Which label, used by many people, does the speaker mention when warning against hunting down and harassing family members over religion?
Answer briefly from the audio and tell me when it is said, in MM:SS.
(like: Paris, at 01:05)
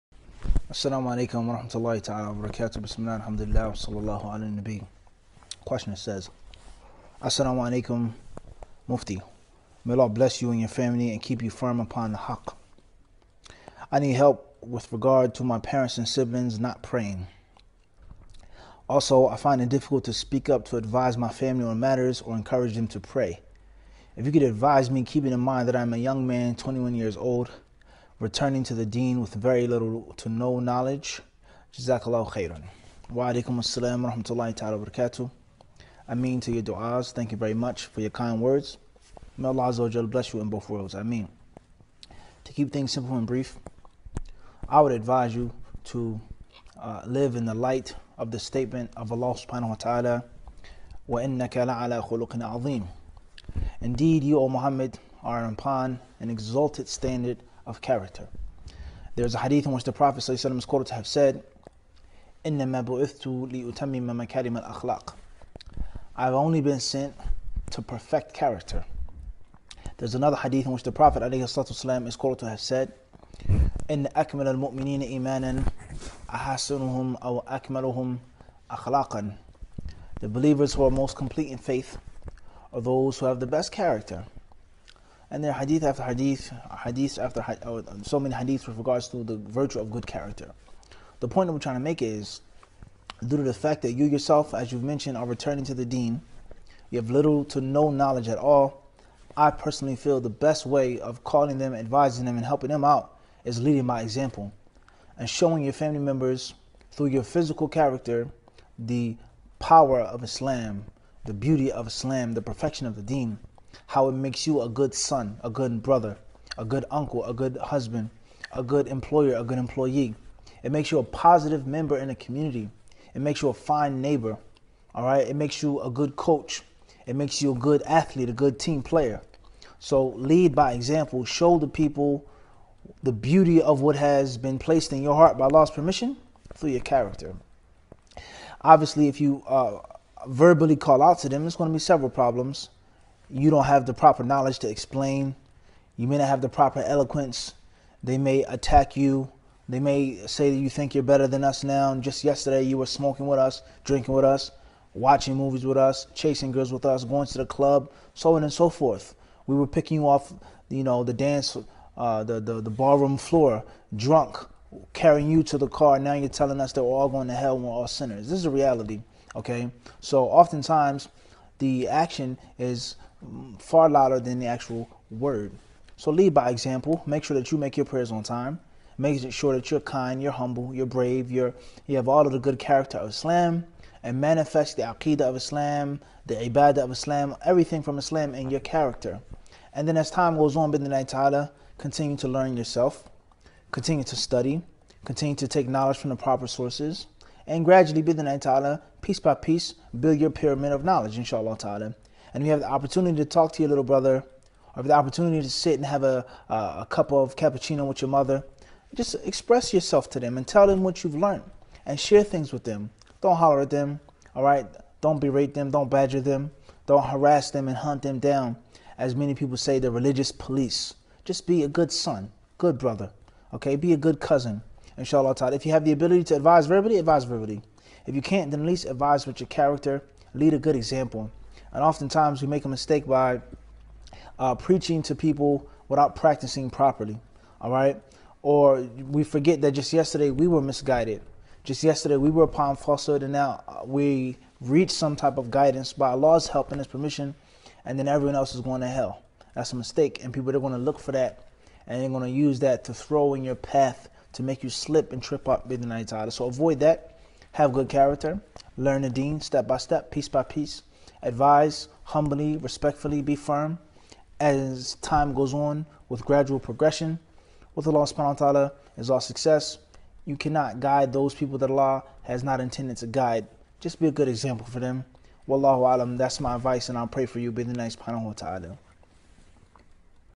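Religious police, at 03:39.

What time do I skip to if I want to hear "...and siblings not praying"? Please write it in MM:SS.
00:15.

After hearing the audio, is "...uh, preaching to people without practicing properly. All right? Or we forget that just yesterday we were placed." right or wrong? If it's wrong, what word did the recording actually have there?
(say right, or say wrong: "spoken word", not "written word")
wrong: "misguided", not "placed".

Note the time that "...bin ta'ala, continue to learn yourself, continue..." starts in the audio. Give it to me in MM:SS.
03:10.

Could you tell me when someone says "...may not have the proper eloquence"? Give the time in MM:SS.
02:26.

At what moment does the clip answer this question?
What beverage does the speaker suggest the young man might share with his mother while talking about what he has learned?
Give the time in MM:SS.
03:27.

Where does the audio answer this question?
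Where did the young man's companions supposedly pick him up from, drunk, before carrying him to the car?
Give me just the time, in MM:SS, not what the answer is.
02:42.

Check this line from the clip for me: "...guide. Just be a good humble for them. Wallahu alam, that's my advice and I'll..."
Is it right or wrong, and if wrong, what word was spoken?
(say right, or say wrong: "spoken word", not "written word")
wrong: "example", not "humble".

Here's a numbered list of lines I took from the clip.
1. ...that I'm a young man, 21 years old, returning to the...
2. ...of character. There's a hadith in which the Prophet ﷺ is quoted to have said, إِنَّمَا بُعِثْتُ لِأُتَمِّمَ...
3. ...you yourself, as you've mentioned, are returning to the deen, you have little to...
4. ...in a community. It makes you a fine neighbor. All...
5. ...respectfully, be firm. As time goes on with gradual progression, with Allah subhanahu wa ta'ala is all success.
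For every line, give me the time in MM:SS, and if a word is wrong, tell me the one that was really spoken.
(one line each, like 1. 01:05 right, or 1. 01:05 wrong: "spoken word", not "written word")
1. 00:25 right
2. 00:57 right
3. 01:33 right
4. 02:01 right
5. 04:22 right.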